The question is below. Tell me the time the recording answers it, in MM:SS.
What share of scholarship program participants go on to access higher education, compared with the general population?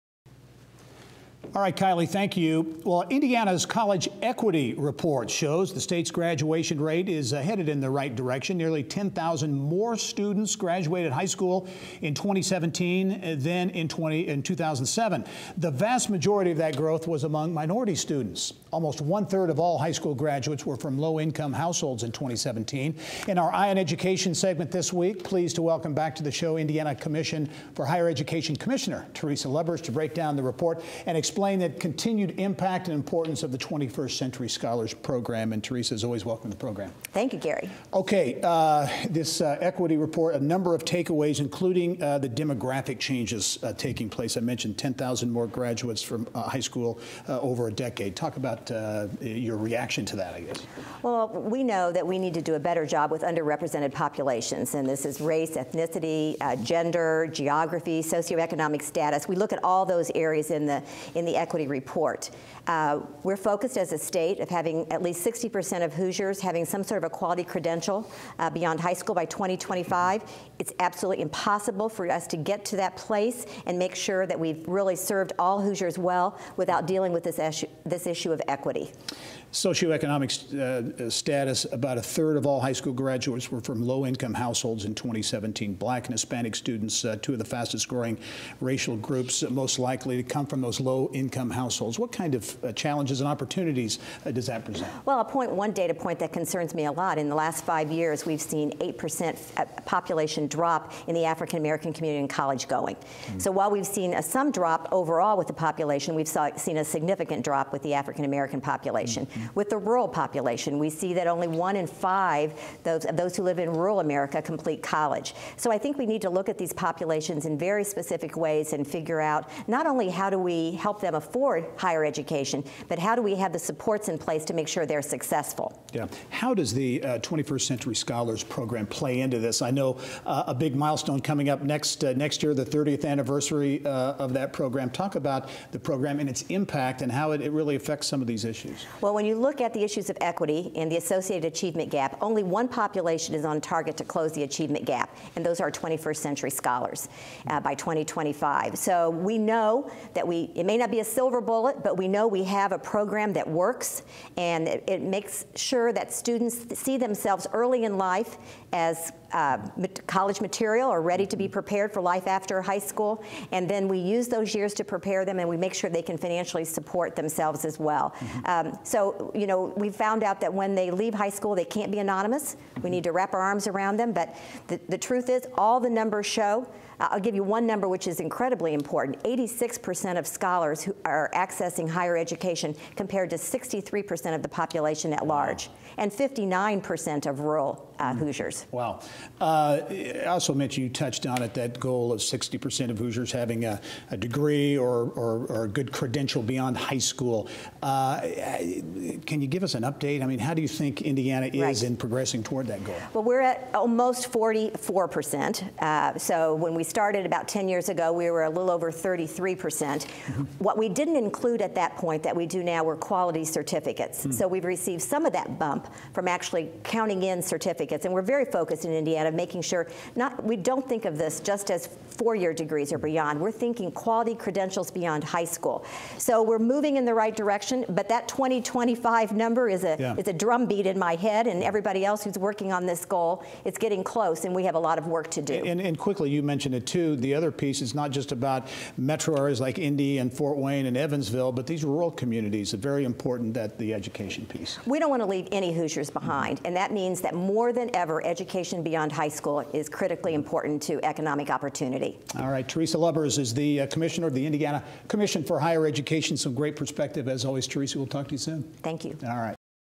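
02:59.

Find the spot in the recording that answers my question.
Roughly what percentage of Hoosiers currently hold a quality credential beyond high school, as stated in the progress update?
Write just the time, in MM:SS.
03:23.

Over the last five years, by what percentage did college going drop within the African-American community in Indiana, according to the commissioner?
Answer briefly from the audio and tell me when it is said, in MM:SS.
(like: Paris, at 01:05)
8%, at 01:38.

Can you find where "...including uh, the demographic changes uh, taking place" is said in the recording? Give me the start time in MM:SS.
00:41.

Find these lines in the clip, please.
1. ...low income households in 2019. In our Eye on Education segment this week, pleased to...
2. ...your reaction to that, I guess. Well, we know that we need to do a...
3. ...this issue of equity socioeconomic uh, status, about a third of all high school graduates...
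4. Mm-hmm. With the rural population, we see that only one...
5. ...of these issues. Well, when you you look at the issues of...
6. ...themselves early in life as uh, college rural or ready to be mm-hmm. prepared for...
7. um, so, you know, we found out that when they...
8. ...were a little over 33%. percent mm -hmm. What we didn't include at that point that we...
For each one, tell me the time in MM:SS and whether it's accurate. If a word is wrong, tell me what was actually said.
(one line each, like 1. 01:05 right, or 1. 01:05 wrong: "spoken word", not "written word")
1. 00:20 wrong: "2017", not "2019"
2. 00:49 right
3. 01:17 right
4. 01:49 right
5. 02:18 right
6. 02:36 wrong: "material", not "rural"
7. 02:48 right
8. 03:28 right.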